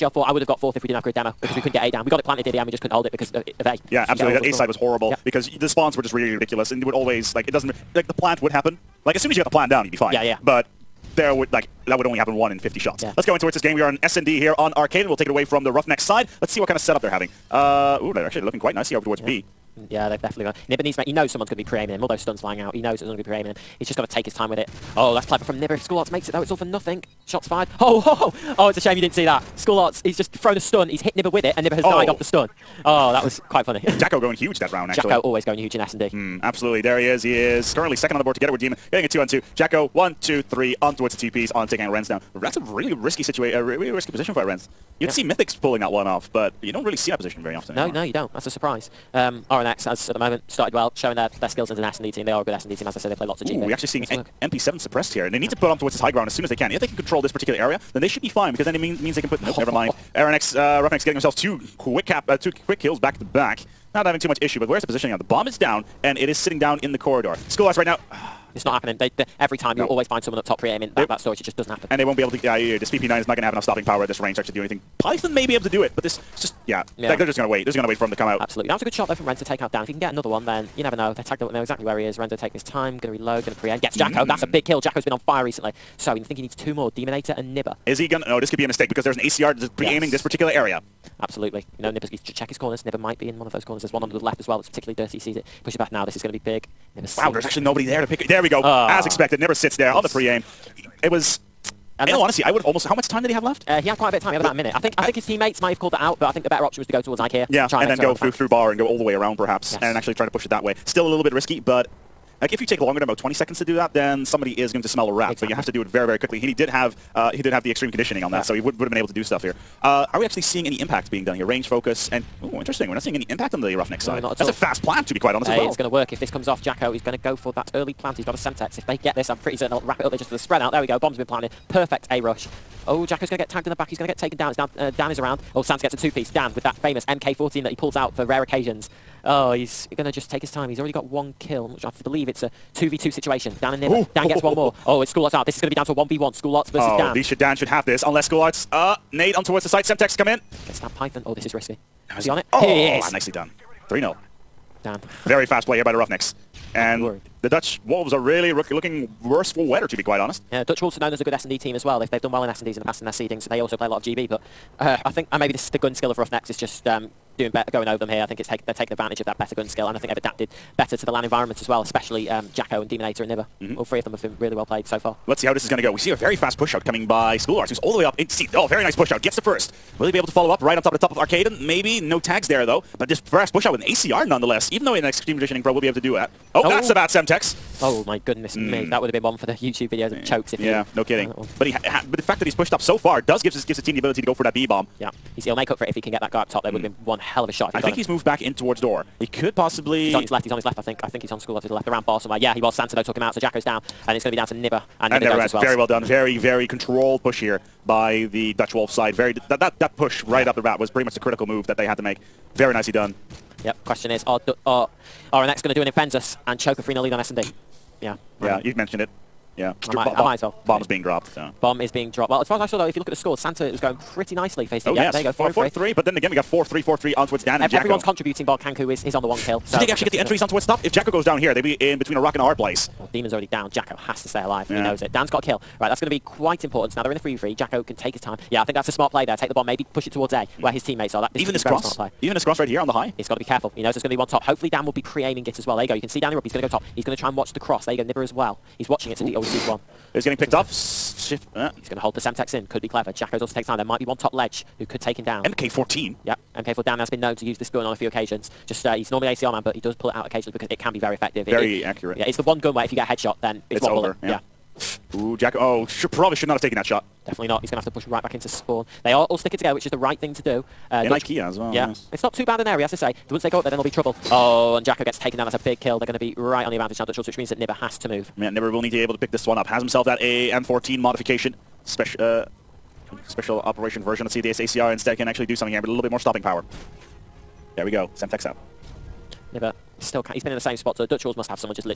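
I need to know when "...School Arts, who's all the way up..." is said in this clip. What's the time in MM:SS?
02:57.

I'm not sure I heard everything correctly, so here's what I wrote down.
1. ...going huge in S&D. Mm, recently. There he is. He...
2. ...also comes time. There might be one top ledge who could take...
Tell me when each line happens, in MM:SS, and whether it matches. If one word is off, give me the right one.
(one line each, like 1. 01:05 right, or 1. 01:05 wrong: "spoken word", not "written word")
1. 00:35 wrong: "absolutely", not "recently"
2. 04:13 wrong: "takes", not "comes".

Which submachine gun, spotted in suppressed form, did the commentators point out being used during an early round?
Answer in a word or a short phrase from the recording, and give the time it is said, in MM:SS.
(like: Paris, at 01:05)
MP7, at 00:54.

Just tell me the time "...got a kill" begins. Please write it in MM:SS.
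03:55.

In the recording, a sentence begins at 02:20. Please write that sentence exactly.
He's already got one kill, which I believe it's a 2v2 situation.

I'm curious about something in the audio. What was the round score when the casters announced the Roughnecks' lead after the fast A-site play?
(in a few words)
3-0.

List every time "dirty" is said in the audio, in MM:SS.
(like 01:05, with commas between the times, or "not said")
01:34.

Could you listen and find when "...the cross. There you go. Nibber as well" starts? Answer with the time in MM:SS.
04:07.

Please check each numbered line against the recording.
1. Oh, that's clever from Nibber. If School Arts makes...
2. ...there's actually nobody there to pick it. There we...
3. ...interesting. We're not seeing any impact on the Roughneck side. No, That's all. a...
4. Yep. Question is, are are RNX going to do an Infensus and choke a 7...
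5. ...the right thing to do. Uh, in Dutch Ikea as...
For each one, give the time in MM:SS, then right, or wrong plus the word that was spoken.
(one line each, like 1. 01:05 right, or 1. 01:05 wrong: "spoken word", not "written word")
1. 00:24 right
2. 01:37 right
3. 02:02 right
4. 03:33 wrong: "3", not "7"
5. 04:29 right.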